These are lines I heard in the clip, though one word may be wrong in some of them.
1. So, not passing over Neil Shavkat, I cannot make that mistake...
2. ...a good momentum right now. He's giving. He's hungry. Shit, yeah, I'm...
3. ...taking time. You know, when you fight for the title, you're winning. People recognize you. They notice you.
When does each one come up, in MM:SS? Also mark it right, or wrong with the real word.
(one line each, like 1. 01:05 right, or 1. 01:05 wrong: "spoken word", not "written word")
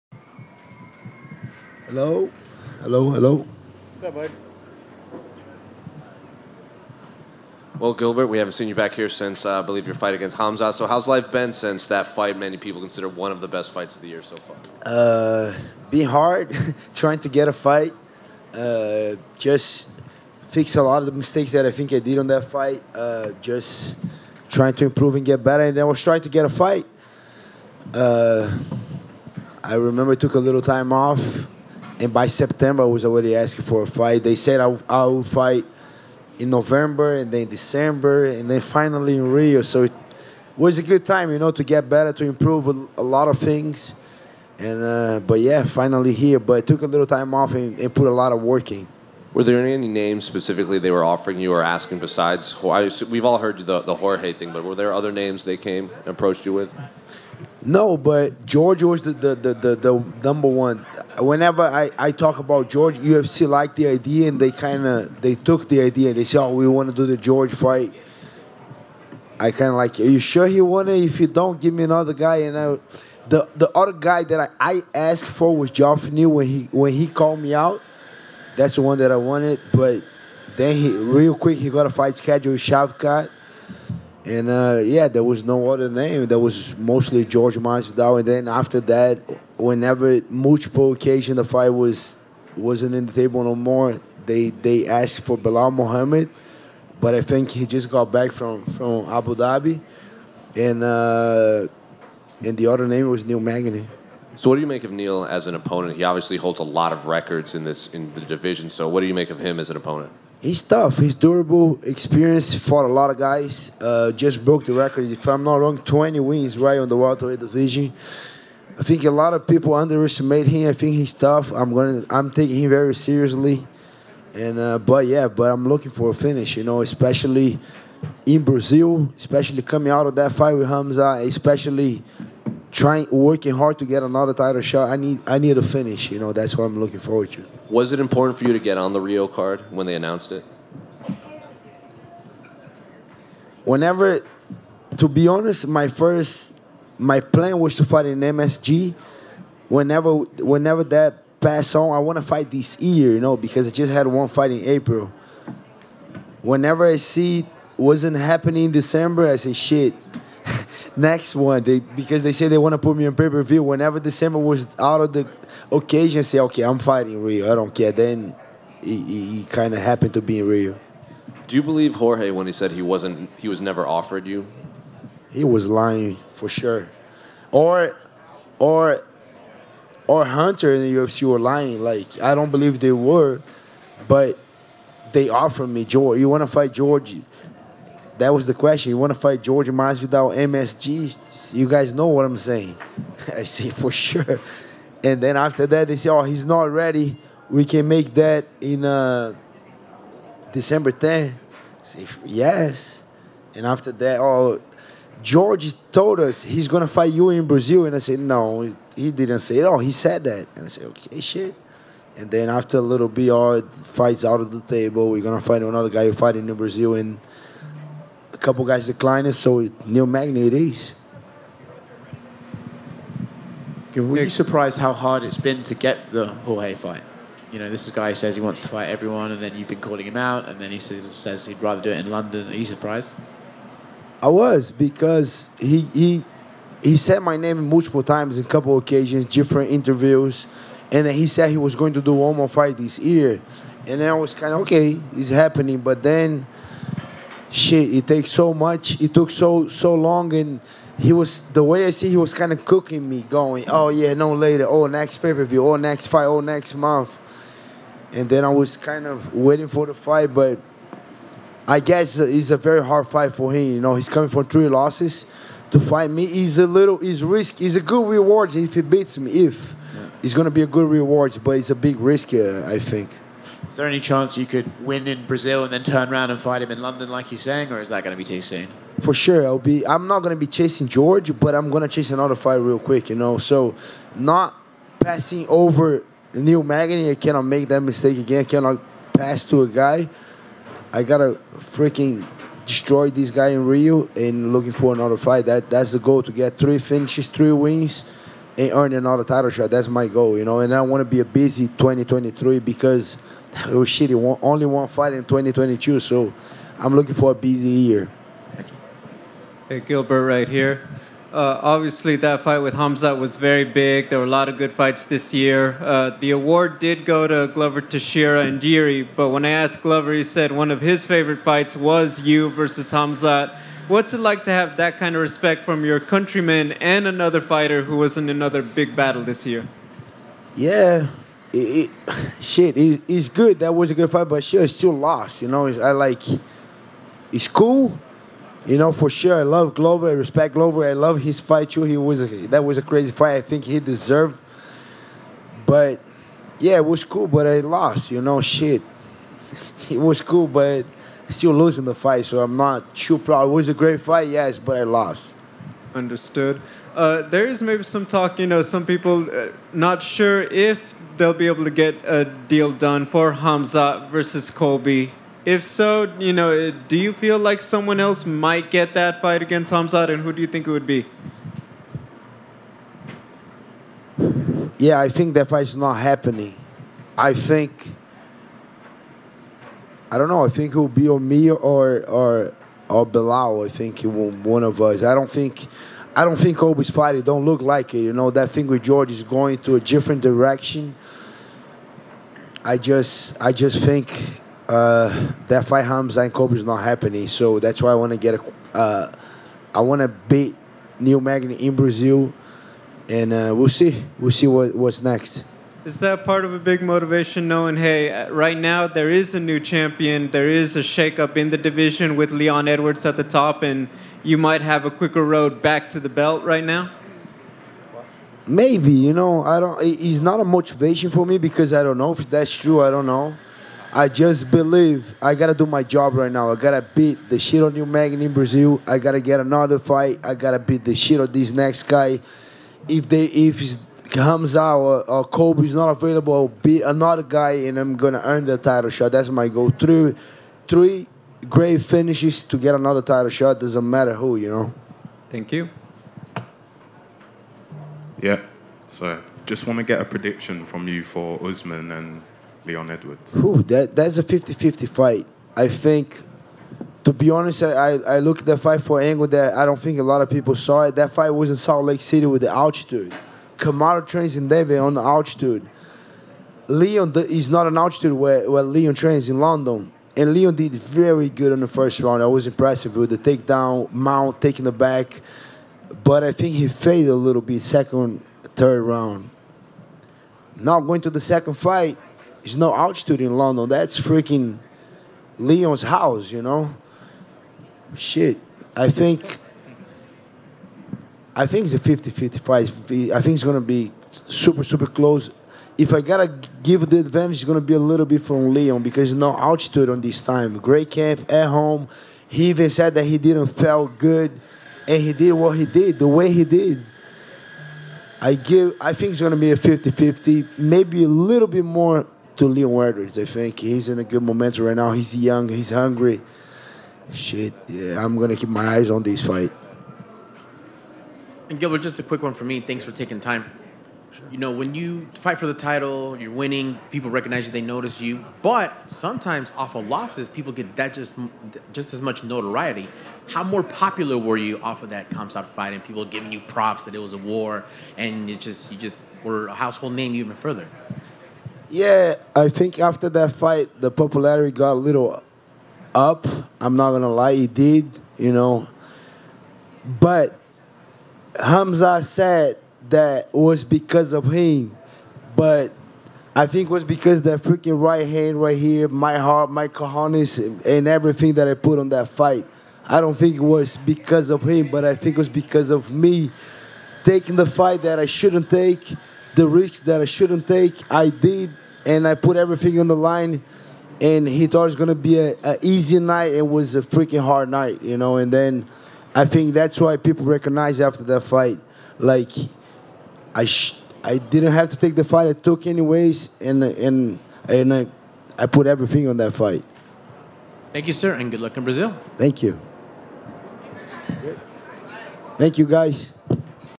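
1. 04:43 wrong: "Magny", not "Shavkat"
2. 08:33 wrong: "young", not "giving"
3. 08:42 right.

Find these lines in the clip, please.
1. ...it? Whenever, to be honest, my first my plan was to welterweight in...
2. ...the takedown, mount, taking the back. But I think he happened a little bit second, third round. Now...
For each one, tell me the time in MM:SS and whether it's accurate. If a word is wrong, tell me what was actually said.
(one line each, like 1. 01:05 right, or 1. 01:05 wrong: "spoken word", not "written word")
1. 02:20 wrong: "fight", not "welterweight"
2. 07:53 wrong: "faded", not "happened".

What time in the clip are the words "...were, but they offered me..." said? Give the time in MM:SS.
03:02.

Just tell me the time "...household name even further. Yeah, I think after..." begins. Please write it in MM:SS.
08:59.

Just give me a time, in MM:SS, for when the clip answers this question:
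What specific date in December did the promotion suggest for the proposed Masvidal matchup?
03:20.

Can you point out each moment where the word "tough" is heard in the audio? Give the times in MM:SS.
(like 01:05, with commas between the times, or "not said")
01:50, 02:01.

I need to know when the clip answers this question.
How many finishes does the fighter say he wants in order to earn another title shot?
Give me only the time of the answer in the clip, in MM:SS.
04:56.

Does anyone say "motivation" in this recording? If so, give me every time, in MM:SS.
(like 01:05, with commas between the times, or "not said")
06:46, 07:00.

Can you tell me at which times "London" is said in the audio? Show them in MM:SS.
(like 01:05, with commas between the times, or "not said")
03:52, 04:36, 07:49, 08:03.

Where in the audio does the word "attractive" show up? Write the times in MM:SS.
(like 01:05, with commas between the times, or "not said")
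not said.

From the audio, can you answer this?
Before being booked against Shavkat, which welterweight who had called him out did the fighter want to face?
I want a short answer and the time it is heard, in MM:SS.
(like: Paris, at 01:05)
Geoffrey Neal, at 01:15.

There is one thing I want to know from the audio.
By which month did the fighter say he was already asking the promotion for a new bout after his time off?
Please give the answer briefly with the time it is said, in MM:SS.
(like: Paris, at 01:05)
September, at 00:32.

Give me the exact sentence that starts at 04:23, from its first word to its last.
You know, he's coming from three losses.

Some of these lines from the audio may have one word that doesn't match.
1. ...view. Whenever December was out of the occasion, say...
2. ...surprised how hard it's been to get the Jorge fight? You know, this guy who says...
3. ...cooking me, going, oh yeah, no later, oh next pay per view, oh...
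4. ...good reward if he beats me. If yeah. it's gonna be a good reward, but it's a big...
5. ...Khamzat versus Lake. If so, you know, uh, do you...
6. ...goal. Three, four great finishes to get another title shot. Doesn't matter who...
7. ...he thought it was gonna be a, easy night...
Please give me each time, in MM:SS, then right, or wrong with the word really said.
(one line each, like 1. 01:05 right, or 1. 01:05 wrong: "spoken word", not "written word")
1. 02:43 right
2. 03:44 right
3. 04:12 right
4. 04:27 right
5. 06:03 wrong: "Colby", not "Lake"
6. 07:19 wrong: "three", not "four"
7. 09:34 right.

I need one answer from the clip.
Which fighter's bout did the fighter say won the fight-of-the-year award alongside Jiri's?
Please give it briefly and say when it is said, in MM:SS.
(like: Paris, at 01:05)
Glover Teixeira, at 05:17.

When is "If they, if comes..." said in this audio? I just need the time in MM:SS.
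07:12.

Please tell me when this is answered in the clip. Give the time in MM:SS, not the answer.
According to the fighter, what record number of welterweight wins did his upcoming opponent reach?
01:55.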